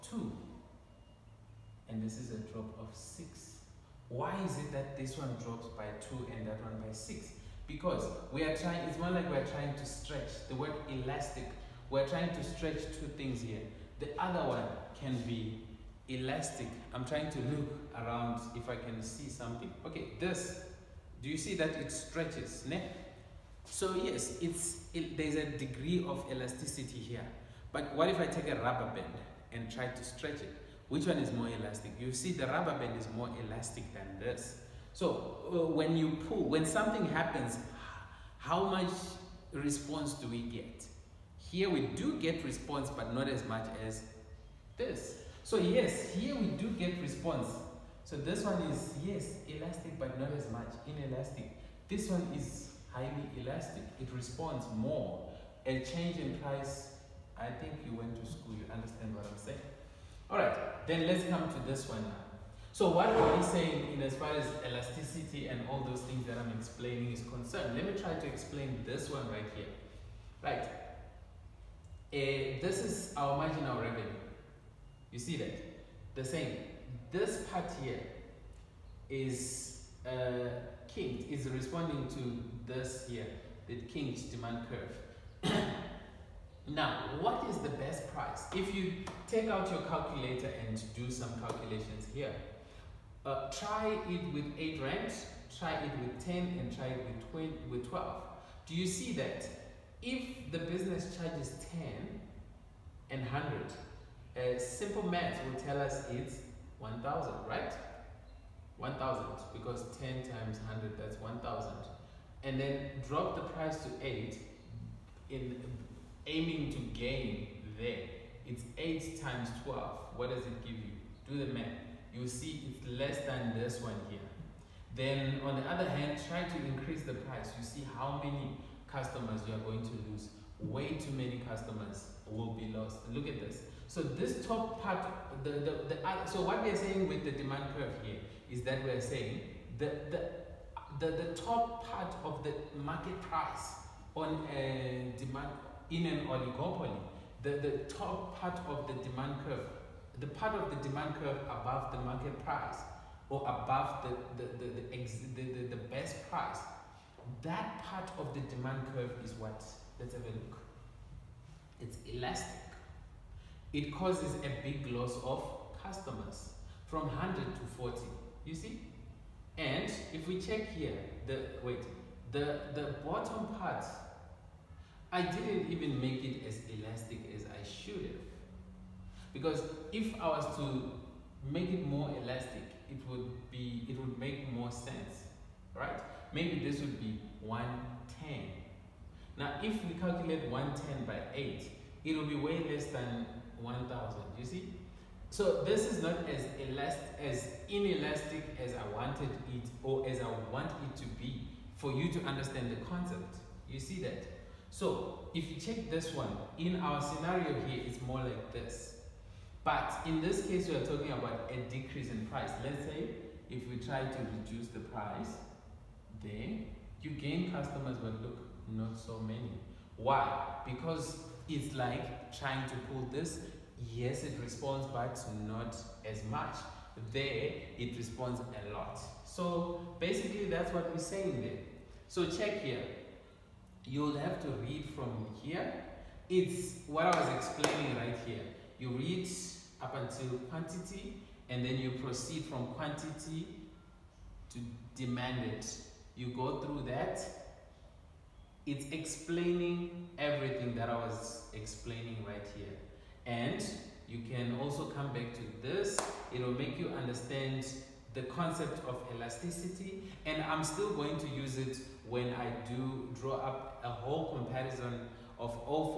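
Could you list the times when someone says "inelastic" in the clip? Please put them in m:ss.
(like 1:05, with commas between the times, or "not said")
0:50, 3:17.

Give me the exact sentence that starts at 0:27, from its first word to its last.
But what if I take a rubber band and try to stretch it?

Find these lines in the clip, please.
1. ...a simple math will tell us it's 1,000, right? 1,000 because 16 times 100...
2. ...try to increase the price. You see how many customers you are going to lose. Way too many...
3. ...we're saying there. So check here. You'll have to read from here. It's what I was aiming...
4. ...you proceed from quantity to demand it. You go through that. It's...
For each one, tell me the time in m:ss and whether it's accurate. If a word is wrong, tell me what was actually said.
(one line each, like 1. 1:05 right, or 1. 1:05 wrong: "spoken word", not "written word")
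1. 1:44 wrong: "10", not "16"
2. 2:06 right
3. 3:50 wrong: "explaining", not "aiming"
4. 4:01 right.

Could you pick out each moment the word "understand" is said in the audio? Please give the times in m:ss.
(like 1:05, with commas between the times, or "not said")
0:58, 3:22, 4:17.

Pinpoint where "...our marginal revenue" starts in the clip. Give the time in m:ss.
1:13.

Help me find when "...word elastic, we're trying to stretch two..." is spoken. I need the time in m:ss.
0:10.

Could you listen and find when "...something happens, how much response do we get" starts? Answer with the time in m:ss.
0:36.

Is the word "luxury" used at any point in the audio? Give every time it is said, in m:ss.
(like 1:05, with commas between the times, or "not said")
not said.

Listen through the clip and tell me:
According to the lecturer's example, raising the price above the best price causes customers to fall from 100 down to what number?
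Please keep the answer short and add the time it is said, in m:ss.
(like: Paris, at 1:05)
40, at 2:47.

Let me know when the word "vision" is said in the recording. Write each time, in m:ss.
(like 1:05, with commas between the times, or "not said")
not said.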